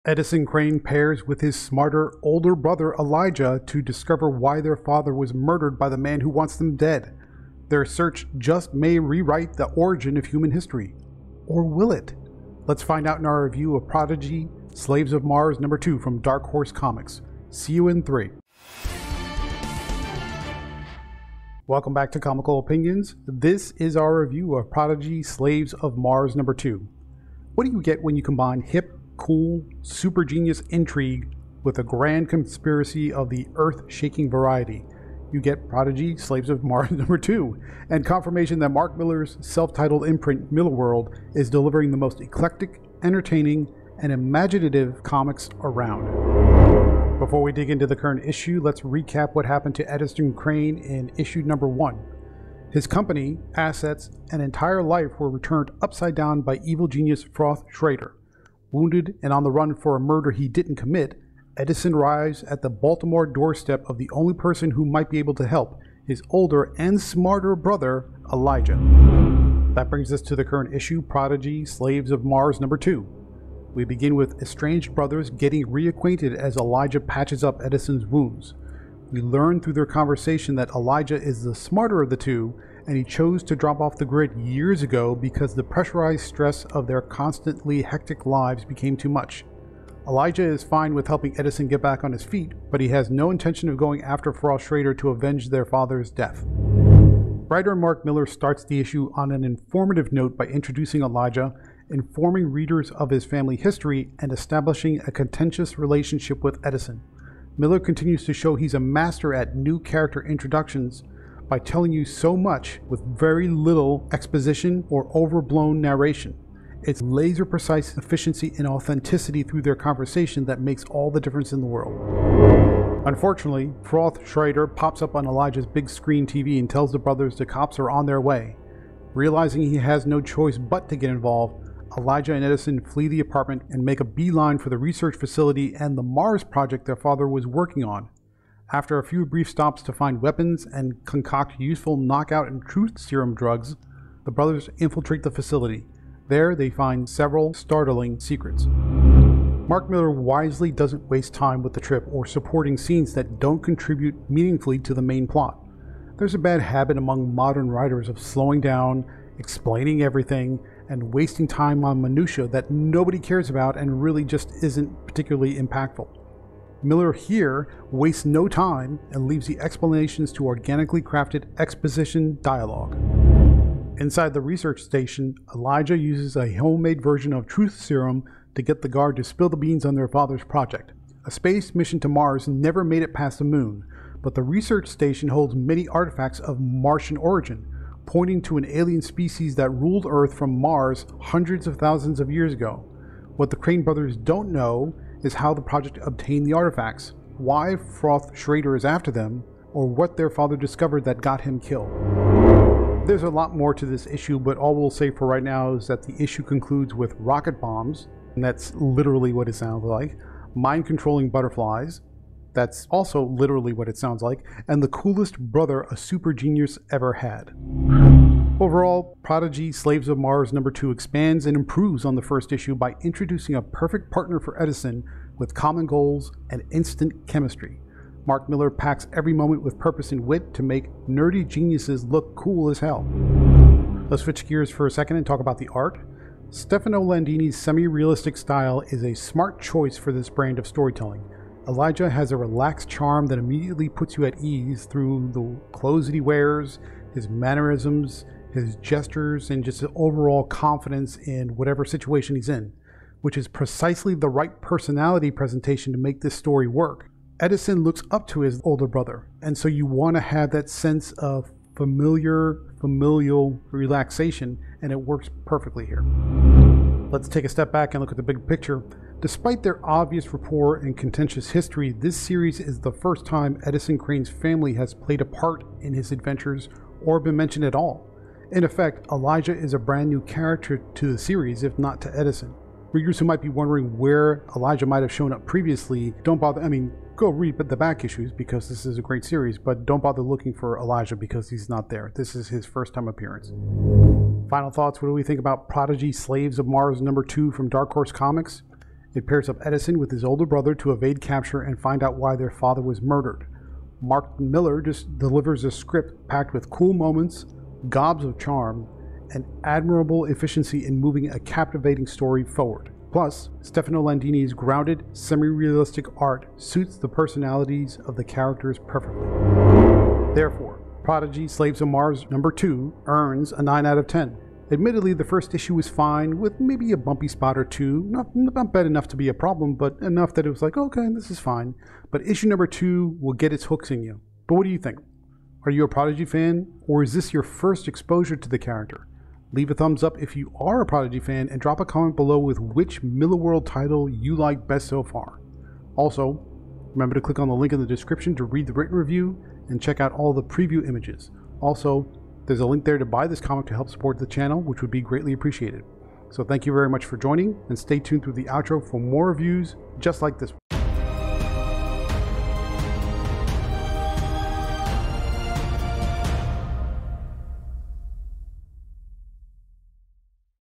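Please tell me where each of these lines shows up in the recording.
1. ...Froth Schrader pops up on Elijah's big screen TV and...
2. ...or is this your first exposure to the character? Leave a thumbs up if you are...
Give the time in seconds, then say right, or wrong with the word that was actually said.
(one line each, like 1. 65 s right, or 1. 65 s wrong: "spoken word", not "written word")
1. 123 s right
2. 336 s right.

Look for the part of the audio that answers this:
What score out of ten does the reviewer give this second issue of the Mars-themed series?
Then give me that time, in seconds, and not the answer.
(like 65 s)
323 s.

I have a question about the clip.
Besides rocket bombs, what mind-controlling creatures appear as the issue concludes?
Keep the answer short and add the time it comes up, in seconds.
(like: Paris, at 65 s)
butterflies, at 211 s.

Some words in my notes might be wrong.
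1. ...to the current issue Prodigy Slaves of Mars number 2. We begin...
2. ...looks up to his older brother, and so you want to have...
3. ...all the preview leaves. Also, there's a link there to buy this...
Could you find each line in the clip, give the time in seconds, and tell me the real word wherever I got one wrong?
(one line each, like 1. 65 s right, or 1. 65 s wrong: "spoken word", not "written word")
1. 70 s right
2. 257 s right
3. 350 s wrong: "images", not "leaves".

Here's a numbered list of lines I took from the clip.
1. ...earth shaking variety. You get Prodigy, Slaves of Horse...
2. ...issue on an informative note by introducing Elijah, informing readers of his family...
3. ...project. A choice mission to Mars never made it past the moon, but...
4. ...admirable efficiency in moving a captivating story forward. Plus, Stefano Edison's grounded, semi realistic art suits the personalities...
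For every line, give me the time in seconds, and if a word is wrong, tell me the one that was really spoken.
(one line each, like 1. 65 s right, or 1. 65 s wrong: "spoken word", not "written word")
1. 33 s wrong: "Mars", not "Horse"
2. 98 s right
3. 180 s wrong: "space", not "choice"
4. 309 s wrong: "Landini", not "Edison".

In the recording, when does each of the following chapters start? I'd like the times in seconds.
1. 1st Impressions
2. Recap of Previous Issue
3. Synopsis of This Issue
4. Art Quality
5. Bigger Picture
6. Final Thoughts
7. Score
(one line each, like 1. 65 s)
1. 21 s
2. 47 s
3. 69 s
4. 234 s
5. 267 s
6. 294 s
7. 322 s.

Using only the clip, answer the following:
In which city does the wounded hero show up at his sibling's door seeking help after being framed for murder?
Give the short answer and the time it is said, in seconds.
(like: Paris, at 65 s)
Baltimore, at 62 s.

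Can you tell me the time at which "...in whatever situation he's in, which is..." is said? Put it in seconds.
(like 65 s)
251 s.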